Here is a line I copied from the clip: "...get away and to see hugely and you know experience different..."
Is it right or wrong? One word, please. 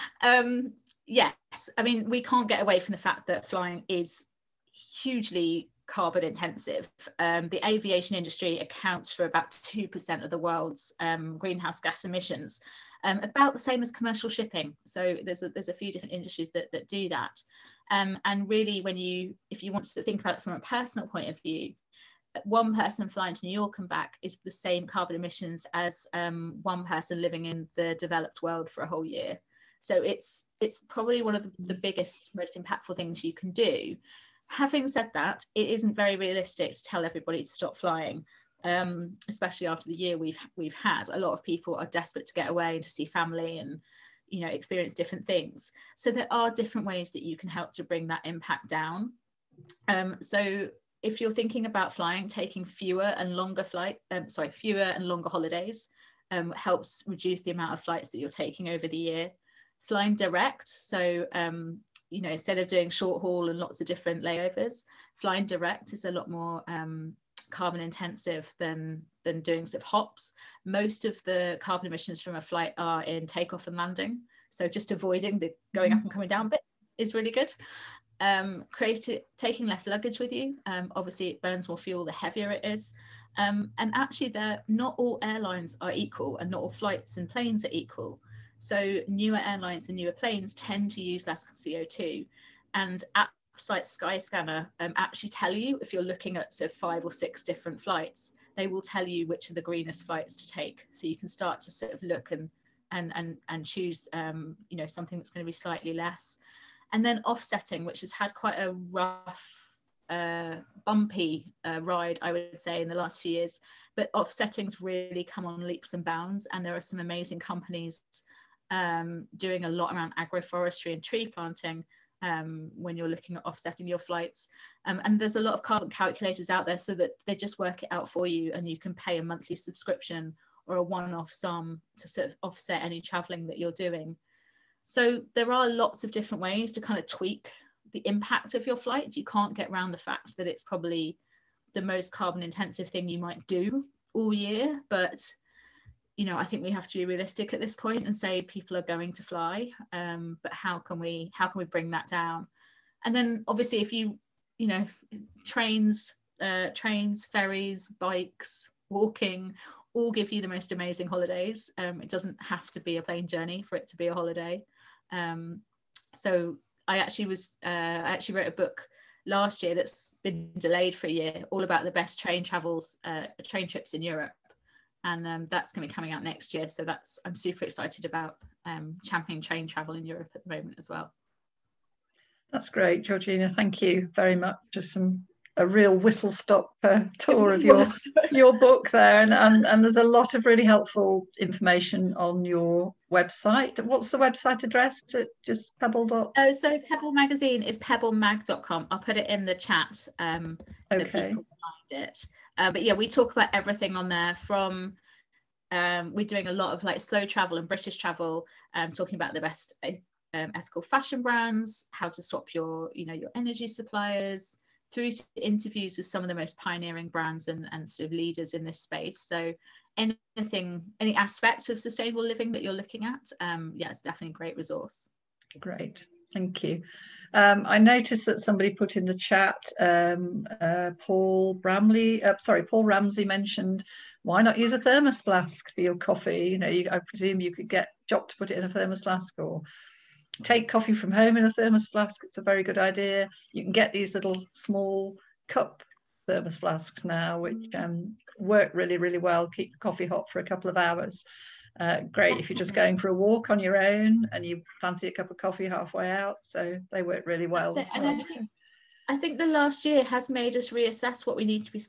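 wrong.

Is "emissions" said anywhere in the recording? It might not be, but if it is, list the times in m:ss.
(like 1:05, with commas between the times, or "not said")
0:12, 0:25, 1:11.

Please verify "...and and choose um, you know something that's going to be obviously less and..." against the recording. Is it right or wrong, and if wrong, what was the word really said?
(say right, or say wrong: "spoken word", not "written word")
wrong: "slightly", not "obviously".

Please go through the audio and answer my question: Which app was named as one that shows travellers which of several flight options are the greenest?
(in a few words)
Skyscanner.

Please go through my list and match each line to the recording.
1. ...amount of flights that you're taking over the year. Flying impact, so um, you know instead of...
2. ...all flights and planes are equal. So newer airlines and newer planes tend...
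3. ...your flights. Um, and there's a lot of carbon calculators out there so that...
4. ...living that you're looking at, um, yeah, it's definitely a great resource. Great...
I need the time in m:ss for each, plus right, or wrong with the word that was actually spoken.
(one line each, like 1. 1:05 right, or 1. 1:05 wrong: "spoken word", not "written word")
1. 0:57 wrong: "direct", not "impact"
2. 1:26 right
3. 2:03 right
4. 3:42 right.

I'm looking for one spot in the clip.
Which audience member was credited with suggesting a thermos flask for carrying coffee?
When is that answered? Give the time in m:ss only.
3:52.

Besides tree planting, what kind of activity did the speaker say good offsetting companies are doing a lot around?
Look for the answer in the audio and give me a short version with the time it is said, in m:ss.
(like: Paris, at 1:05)
agroforestry, at 2:00.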